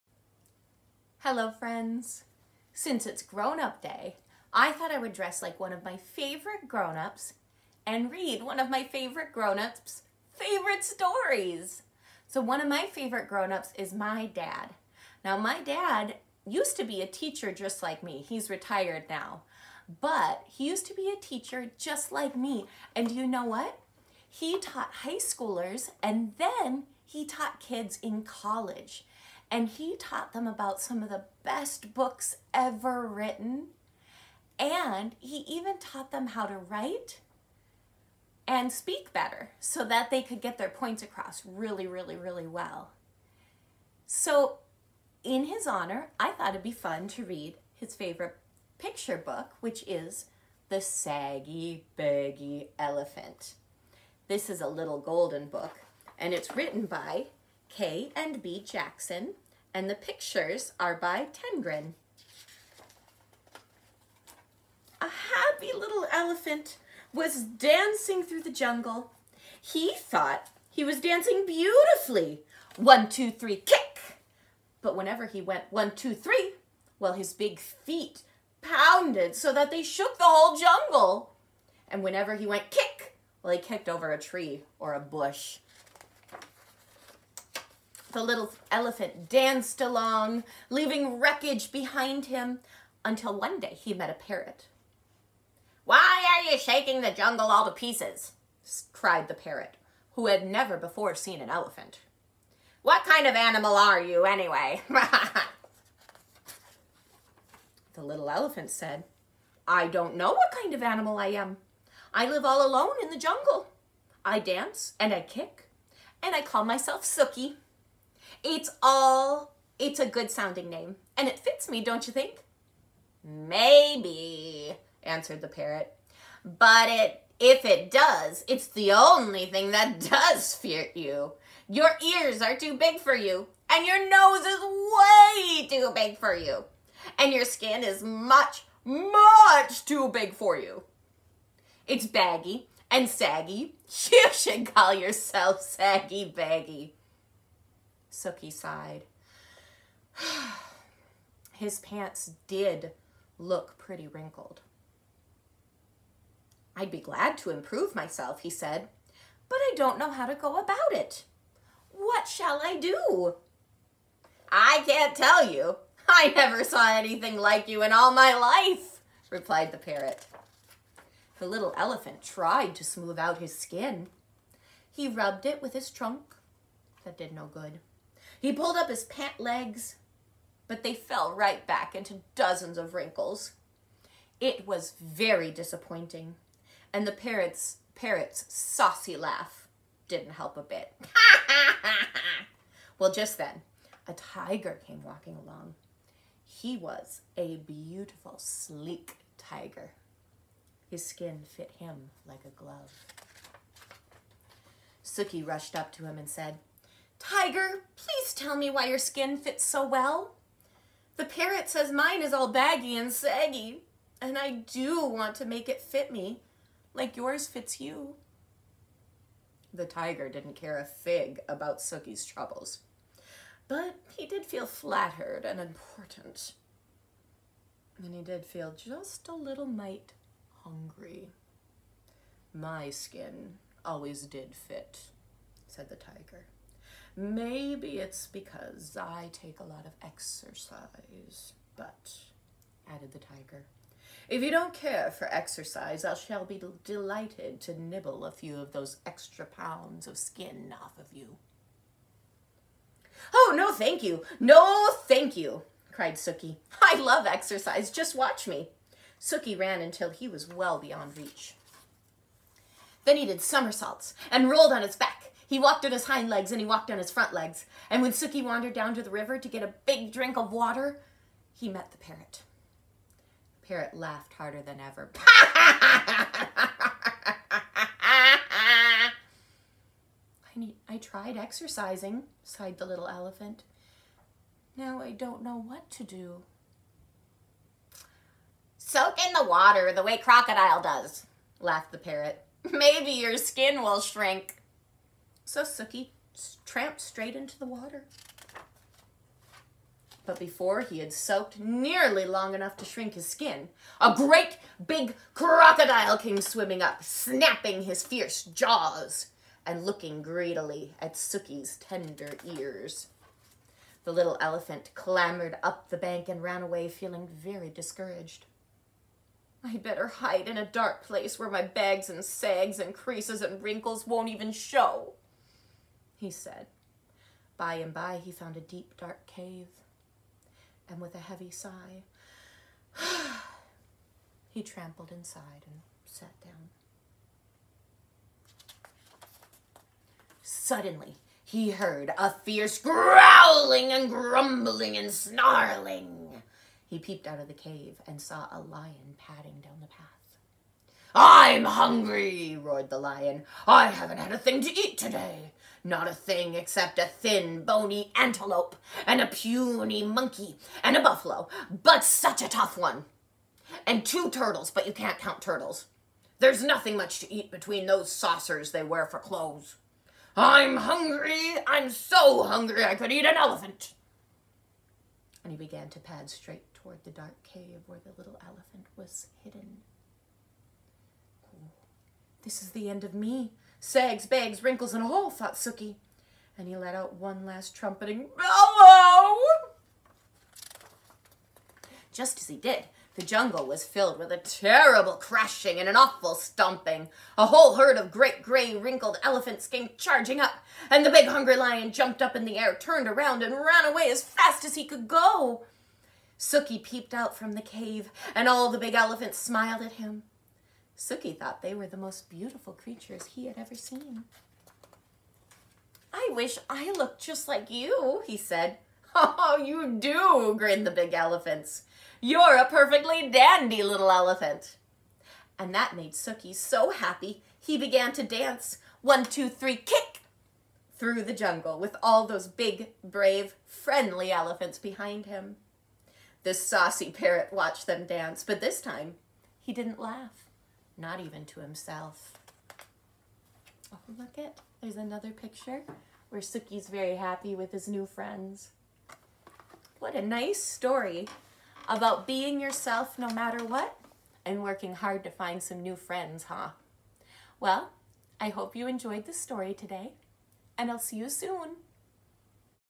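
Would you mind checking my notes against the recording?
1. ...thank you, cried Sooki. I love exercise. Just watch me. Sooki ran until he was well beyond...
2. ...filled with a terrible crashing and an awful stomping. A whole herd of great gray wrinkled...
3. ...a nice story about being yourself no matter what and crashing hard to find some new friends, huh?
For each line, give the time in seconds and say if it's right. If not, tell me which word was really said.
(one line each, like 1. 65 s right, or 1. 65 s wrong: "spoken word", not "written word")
1. 255 s right
2. 393 s right
3. 450 s wrong: "working", not "crashing".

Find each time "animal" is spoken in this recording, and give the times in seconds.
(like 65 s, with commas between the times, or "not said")
103 s, 110 s.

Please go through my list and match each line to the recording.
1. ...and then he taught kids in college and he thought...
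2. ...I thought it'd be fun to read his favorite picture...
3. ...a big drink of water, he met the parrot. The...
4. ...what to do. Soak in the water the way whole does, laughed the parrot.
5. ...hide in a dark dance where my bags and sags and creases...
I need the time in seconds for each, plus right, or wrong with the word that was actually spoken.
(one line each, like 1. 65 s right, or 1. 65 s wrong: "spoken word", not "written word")
1. 26 s wrong: "taught", not "thought"
2. 46 s right
3. 269 s right
4. 285 s wrong: "crocodile", not "whole"
5. 320 s wrong: "place", not "dance".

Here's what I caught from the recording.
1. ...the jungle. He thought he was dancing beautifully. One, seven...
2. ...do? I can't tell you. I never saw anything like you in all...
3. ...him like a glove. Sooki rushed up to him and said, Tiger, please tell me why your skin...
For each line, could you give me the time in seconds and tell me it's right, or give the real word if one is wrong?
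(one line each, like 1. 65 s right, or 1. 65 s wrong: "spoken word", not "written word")
1. 68 s wrong: "two", not "seven"
2. 162 s right
3. 201 s right.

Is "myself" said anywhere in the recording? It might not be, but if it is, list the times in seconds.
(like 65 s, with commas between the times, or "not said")
116 s, 157 s.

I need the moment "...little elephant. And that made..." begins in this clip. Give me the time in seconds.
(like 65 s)
423 s.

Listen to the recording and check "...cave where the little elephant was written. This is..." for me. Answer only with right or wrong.
wrong.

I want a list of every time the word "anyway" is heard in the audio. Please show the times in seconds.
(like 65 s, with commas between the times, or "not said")
104 s.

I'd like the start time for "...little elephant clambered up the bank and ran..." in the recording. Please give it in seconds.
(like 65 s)
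314 s.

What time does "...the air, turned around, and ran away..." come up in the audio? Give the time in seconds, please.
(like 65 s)
402 s.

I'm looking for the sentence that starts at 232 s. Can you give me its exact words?
My skin always did fit, said the tiger.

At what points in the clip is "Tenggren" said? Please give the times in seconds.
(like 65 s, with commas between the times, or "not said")
61 s.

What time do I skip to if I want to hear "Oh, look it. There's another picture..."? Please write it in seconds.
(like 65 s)
443 s.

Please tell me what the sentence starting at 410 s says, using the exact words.
Sooki thought they were the most beautiful creatures he had ever seen.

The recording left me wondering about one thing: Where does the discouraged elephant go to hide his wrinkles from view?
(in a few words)
A deep, dark cave.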